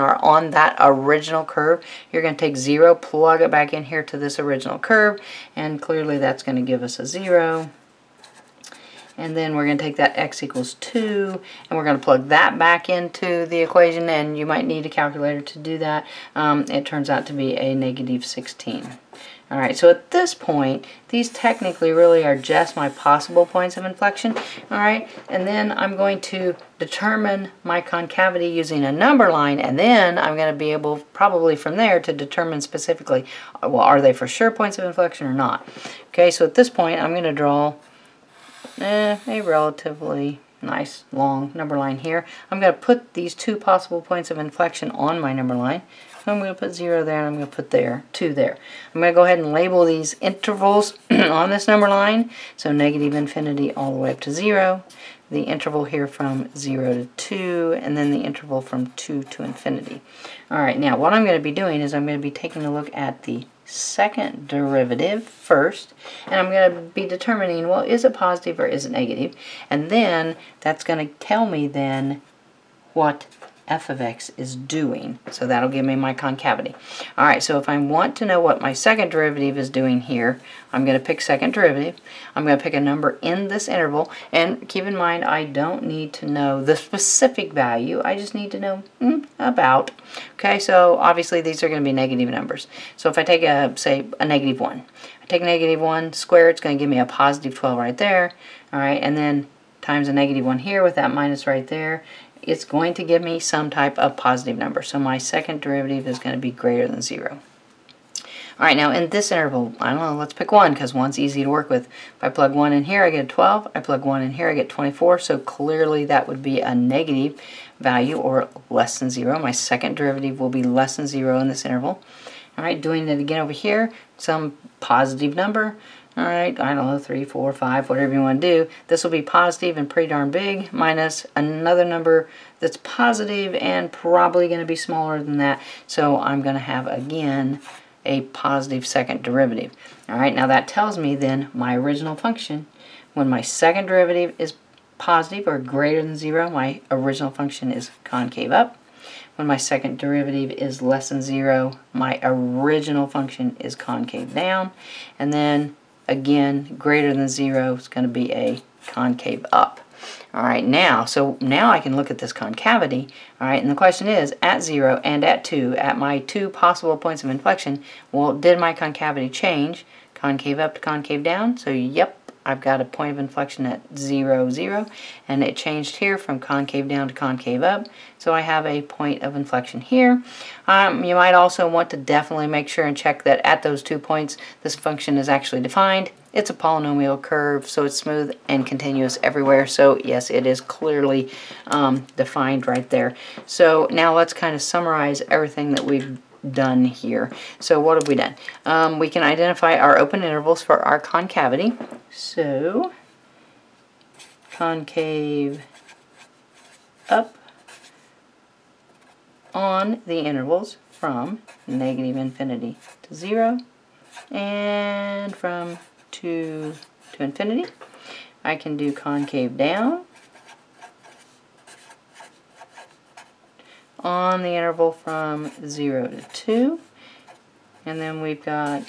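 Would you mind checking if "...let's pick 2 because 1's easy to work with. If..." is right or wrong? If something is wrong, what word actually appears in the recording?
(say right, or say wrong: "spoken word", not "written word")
wrong: "1", not "2".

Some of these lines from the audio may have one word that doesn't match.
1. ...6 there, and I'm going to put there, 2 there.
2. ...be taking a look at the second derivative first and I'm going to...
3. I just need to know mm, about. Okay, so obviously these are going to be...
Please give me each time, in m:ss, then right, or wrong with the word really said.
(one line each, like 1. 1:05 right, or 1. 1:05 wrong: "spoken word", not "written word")
1. 0:46 wrong: "0", not "6"
2. 1:02 right
3. 1:28 right.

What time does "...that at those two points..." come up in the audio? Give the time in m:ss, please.
3:03.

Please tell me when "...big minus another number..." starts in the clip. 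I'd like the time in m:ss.
2:10.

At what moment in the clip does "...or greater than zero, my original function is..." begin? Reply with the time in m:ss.
2:25.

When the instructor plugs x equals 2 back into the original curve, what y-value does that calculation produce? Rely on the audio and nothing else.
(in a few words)
-16.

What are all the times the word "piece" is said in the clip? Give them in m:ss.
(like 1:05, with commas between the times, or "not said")
not said.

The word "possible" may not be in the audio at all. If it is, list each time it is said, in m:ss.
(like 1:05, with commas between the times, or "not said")
0:22, 0:43, 2:46.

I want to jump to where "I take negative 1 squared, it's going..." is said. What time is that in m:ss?
1:35.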